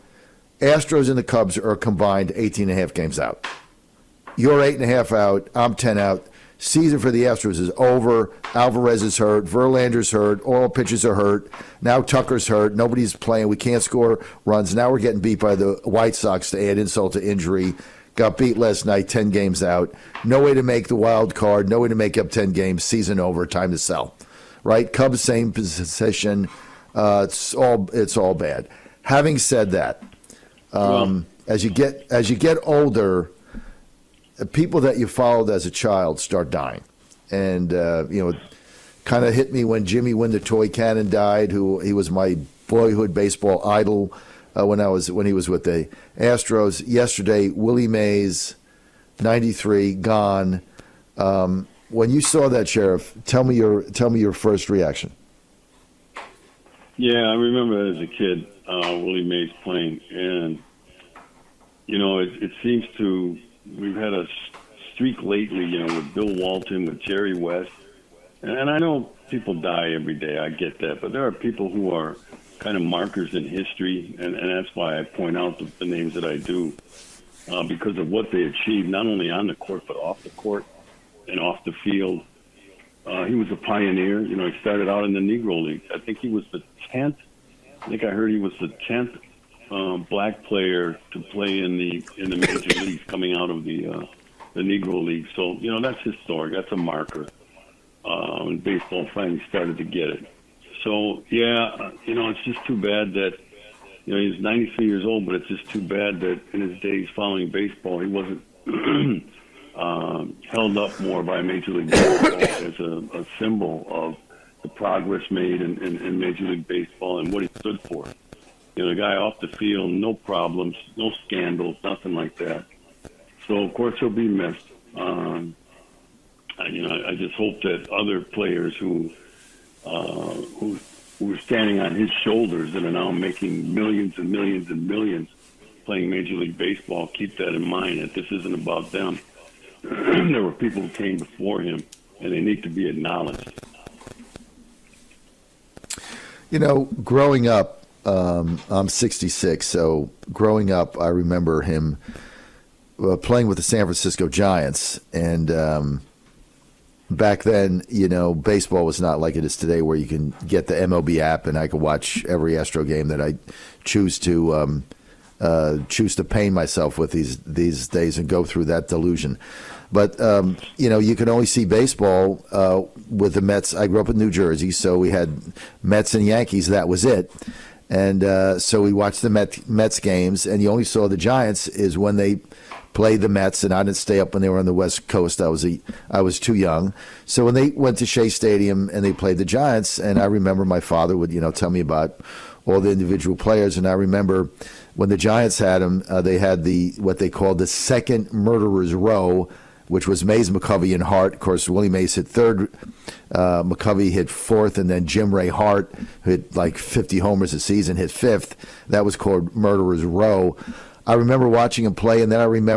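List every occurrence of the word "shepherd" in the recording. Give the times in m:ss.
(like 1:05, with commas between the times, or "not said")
not said.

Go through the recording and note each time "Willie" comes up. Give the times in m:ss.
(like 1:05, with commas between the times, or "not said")
0:47, 0:58, 3:21.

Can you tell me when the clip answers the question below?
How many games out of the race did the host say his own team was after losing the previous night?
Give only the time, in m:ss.
0:05.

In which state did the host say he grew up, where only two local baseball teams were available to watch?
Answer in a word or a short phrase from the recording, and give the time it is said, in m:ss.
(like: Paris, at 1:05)
New Jersey, at 2:54.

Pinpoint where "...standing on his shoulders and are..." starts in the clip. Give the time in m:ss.
2:11.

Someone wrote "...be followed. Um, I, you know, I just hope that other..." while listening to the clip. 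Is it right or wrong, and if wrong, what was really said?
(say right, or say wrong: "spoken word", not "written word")
wrong: "missed", not "followed".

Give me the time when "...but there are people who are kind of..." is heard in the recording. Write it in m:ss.
1:11.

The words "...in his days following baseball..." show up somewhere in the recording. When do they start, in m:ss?
1:46.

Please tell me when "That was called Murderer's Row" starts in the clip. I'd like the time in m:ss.
3:28.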